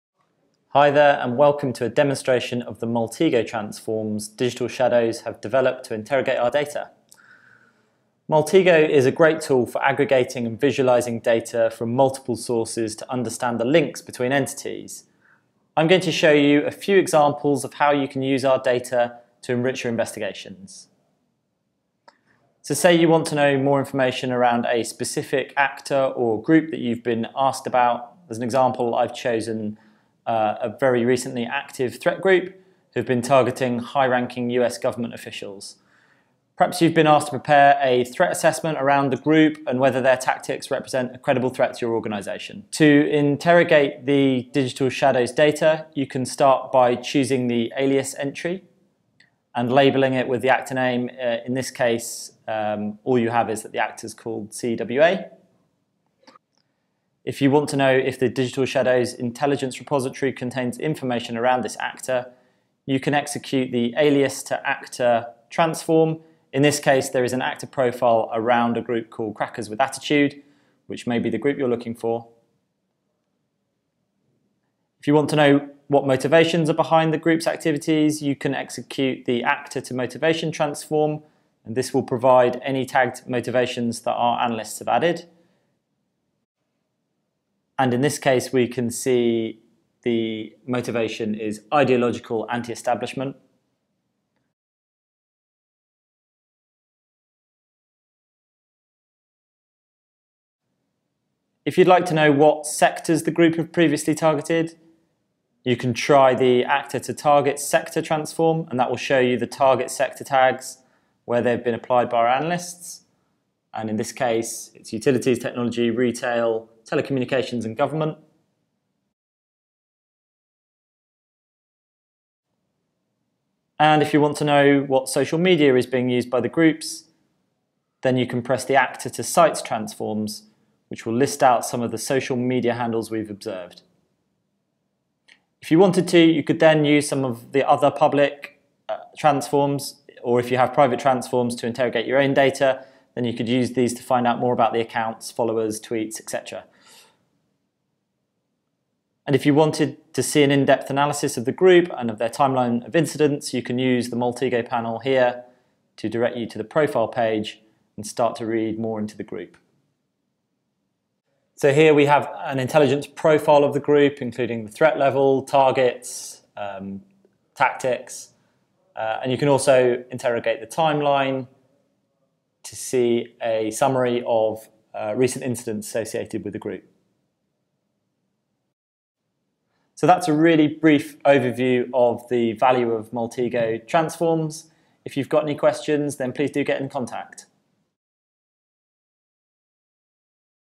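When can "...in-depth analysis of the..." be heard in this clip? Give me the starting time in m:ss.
2:30.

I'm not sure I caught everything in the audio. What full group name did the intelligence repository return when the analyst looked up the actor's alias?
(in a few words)
Crackers with Attitude.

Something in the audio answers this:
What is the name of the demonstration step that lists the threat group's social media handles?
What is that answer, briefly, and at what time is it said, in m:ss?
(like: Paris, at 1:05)
Actor to sites, at 2:08.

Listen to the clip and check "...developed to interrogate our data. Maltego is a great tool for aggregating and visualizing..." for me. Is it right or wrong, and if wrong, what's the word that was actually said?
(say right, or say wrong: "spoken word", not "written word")
right.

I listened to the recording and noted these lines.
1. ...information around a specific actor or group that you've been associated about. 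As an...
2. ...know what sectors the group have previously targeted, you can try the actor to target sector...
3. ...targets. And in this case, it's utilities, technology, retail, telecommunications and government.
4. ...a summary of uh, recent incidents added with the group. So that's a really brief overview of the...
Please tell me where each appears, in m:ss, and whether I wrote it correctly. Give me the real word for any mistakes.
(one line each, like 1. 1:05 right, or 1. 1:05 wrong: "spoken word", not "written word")
1. 0:23 wrong: "asked", not "associated"
2. 1:42 right
3. 1:52 wrong: "analysts", not "targets"
4. 2:53 wrong: "associated", not "added".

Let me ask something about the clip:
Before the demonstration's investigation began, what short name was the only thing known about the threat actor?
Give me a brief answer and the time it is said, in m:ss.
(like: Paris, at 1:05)
CWA, at 0:54.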